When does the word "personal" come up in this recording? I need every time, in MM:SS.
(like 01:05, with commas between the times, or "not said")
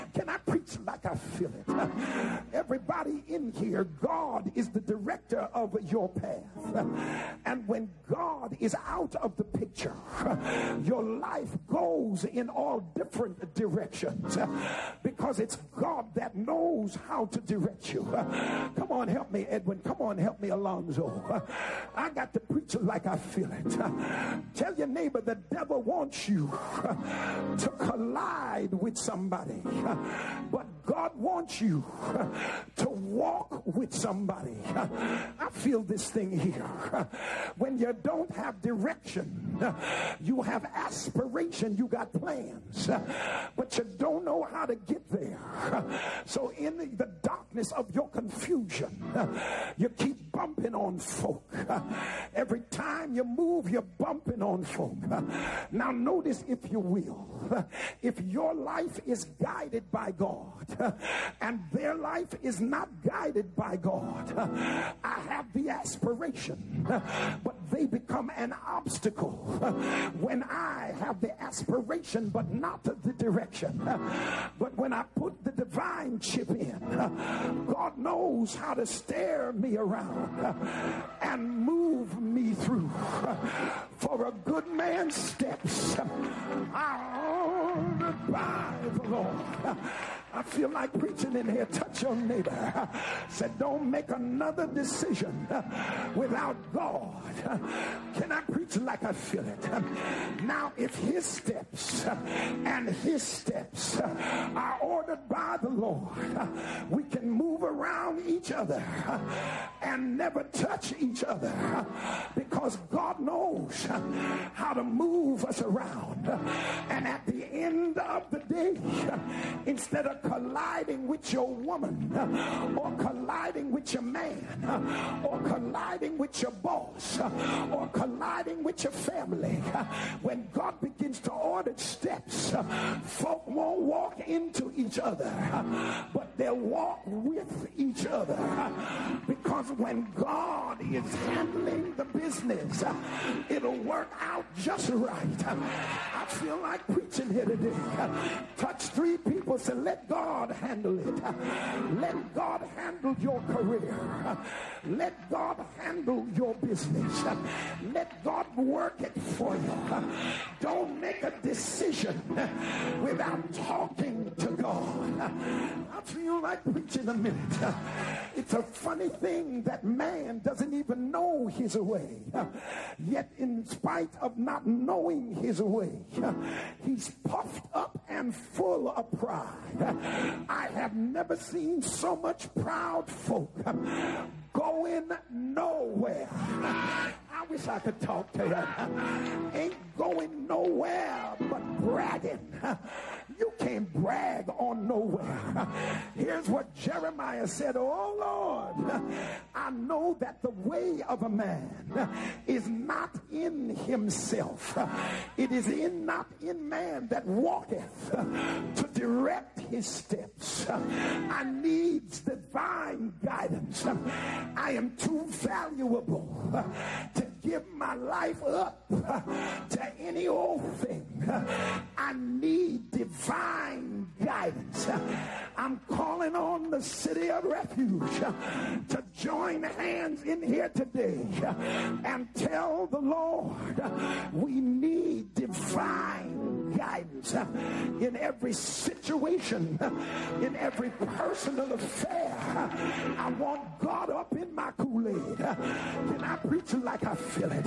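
04:00.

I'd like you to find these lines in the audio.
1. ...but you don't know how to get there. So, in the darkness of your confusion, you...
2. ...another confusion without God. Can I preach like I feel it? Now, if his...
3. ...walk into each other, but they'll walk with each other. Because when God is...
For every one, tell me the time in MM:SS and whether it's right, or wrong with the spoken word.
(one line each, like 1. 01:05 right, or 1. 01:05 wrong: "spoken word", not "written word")
1. 00:43 right
2. 01:34 wrong: "decision", not "confusion"
3. 02:13 right.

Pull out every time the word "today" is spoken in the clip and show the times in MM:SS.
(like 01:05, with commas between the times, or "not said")
01:58, 02:27, 03:50.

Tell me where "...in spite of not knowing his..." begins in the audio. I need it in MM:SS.
02:53.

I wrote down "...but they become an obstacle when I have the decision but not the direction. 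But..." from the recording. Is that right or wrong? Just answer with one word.
wrong.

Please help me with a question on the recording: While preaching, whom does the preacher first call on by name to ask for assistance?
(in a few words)
Edwin.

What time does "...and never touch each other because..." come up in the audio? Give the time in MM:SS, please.
01:49.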